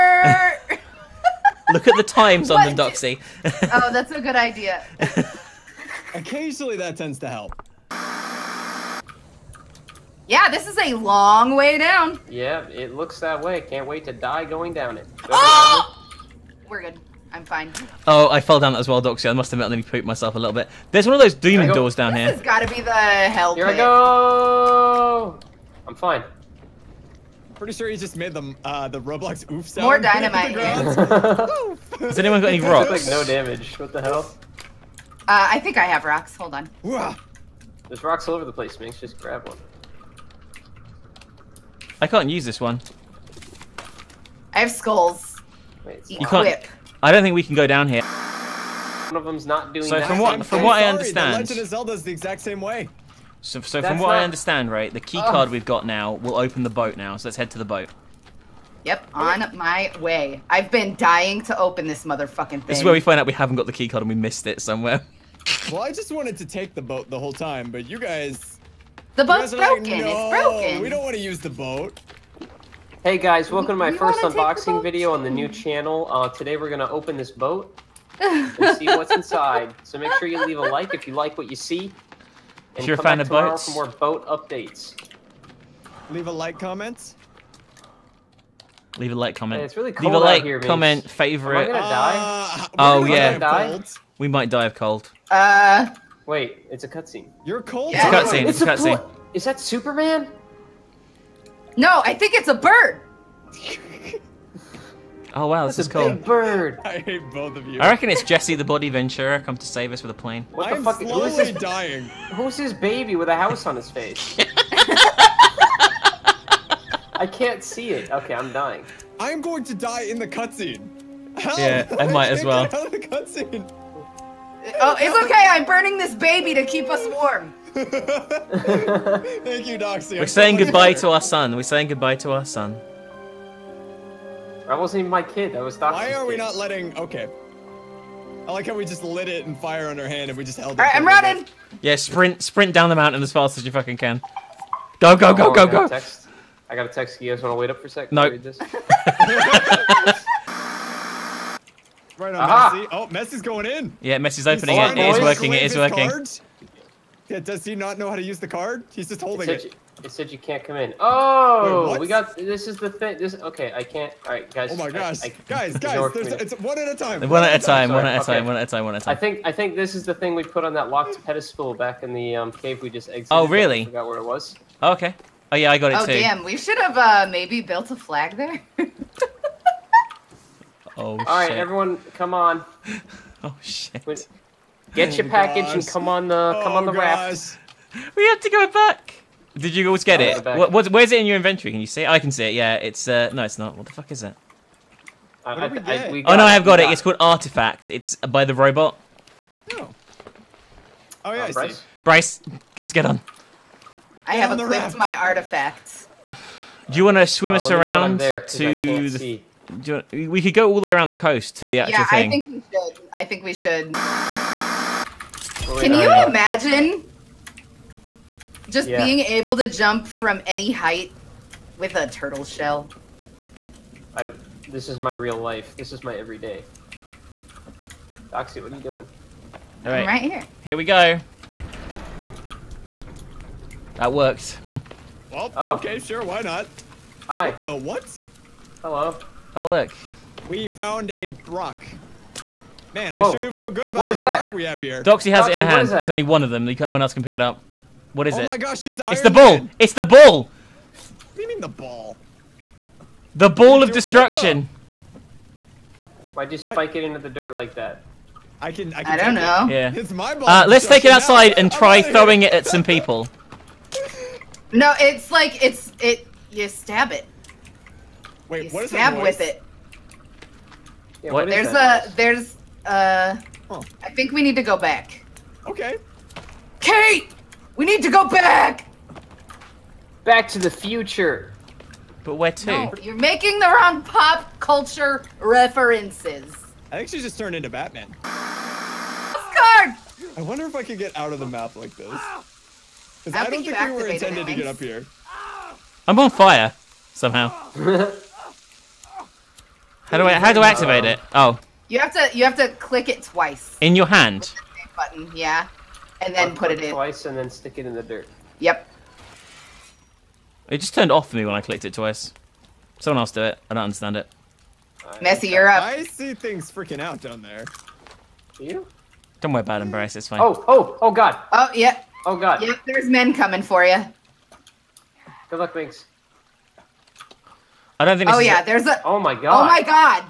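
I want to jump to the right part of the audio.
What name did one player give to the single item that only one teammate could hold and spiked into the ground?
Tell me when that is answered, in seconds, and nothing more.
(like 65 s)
253 s.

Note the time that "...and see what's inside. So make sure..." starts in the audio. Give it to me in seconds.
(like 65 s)
78 s.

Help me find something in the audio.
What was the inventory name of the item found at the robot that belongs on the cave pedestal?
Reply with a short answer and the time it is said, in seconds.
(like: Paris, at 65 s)
Artifact, at 196 s.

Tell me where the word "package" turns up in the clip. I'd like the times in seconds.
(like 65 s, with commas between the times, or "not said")
185 s.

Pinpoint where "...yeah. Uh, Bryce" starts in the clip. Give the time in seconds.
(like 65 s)
201 s.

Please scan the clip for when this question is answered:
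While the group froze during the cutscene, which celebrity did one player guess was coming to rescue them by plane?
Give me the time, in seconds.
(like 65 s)
108 s.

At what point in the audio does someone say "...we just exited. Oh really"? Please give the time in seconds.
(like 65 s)
172 s.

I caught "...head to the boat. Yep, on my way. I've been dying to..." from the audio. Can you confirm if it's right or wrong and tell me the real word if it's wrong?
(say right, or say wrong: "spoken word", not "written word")
right.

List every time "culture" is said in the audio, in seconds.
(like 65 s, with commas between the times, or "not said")
284 s.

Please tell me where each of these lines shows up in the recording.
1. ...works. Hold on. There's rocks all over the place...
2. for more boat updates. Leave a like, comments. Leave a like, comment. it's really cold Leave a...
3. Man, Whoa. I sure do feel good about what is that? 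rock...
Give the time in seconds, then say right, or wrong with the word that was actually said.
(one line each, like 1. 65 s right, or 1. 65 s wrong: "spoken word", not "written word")
1. 36 s wrong: "rocks", not "works"
2. 83 s right
3. 242 s right.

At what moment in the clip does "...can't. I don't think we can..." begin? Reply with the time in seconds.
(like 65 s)
46 s.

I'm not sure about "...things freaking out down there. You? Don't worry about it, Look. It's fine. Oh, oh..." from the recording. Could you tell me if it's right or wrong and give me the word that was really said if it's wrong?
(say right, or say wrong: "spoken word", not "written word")
wrong: "Bryce", not "Look".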